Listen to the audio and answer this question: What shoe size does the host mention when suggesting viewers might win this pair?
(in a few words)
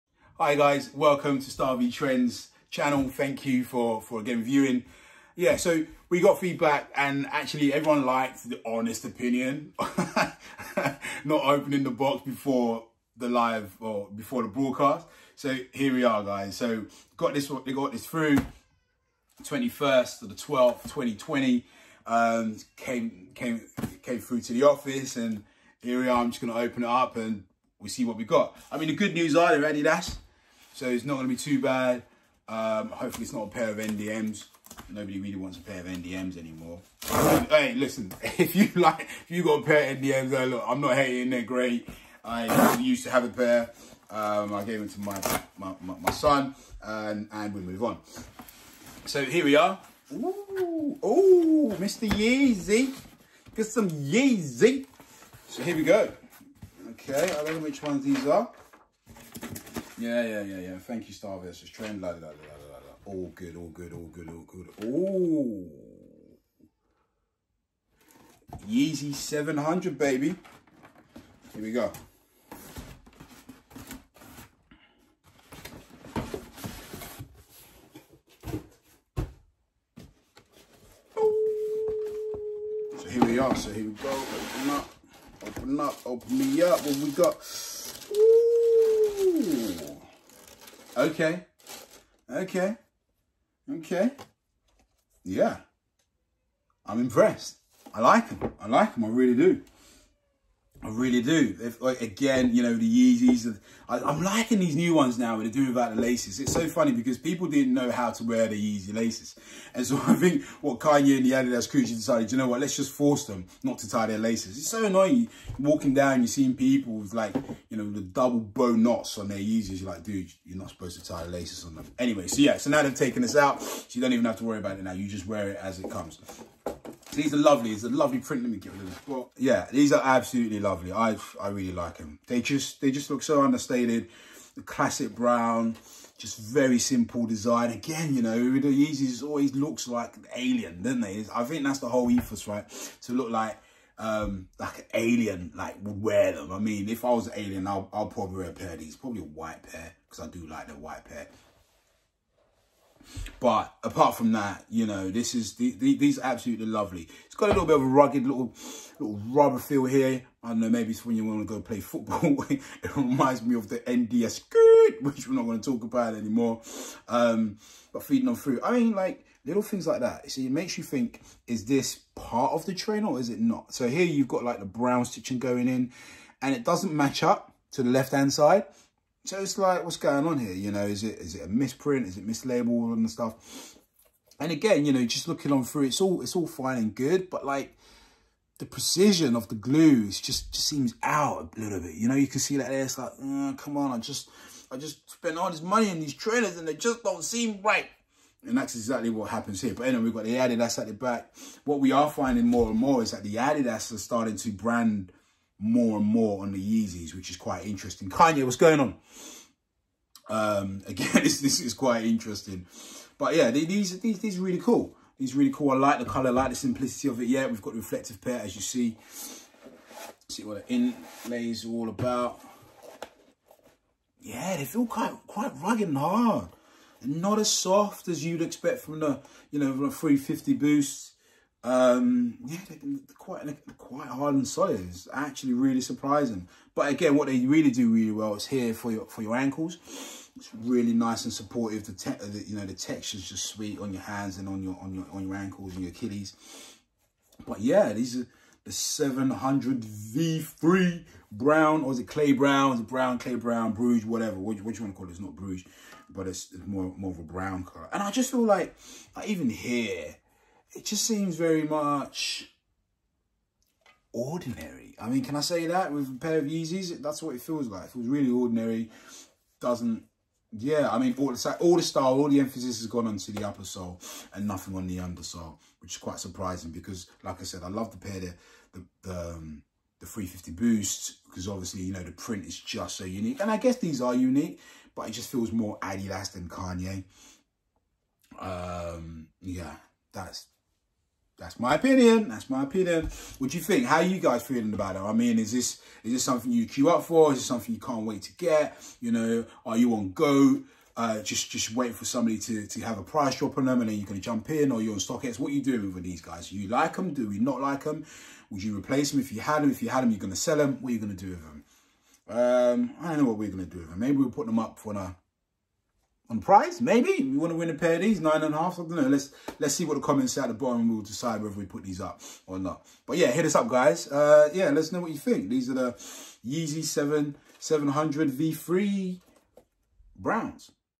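9.5.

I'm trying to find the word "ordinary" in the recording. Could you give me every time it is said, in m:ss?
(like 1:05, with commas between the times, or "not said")
4:24, 4:28.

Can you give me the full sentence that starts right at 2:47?
Um, but feeding on food, I mean, like little things like that.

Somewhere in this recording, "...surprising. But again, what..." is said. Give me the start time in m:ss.
3:55.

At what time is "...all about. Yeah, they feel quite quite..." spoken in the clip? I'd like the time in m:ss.
3:41.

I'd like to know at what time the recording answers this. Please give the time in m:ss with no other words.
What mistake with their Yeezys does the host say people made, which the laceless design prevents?
2:01.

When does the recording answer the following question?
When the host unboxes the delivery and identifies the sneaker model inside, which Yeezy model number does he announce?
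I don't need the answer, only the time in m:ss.
1:08.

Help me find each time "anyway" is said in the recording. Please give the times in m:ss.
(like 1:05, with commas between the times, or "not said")
2:01, 3:19.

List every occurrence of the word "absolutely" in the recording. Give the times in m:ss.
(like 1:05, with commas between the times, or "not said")
2:10, 2:36.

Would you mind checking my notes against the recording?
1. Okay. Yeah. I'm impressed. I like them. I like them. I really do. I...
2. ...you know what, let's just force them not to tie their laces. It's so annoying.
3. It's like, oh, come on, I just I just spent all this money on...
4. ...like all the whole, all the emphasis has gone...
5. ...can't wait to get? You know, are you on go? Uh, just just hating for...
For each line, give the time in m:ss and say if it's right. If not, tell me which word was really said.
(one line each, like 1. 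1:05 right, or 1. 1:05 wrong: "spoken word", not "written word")
1. 1:33 right
2. 1:52 right
3. 3:12 right
4. 4:31 wrong: "style", not "whole"
5. 4:57 wrong: "waiting", not "hating".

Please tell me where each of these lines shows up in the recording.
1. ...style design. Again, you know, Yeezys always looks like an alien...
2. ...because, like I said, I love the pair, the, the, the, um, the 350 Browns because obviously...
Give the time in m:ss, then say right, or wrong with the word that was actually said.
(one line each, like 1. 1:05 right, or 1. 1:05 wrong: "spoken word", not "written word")
1. 2:16 wrong: "simple", not "style"
2. 4:36 wrong: "Boost", not "Browns".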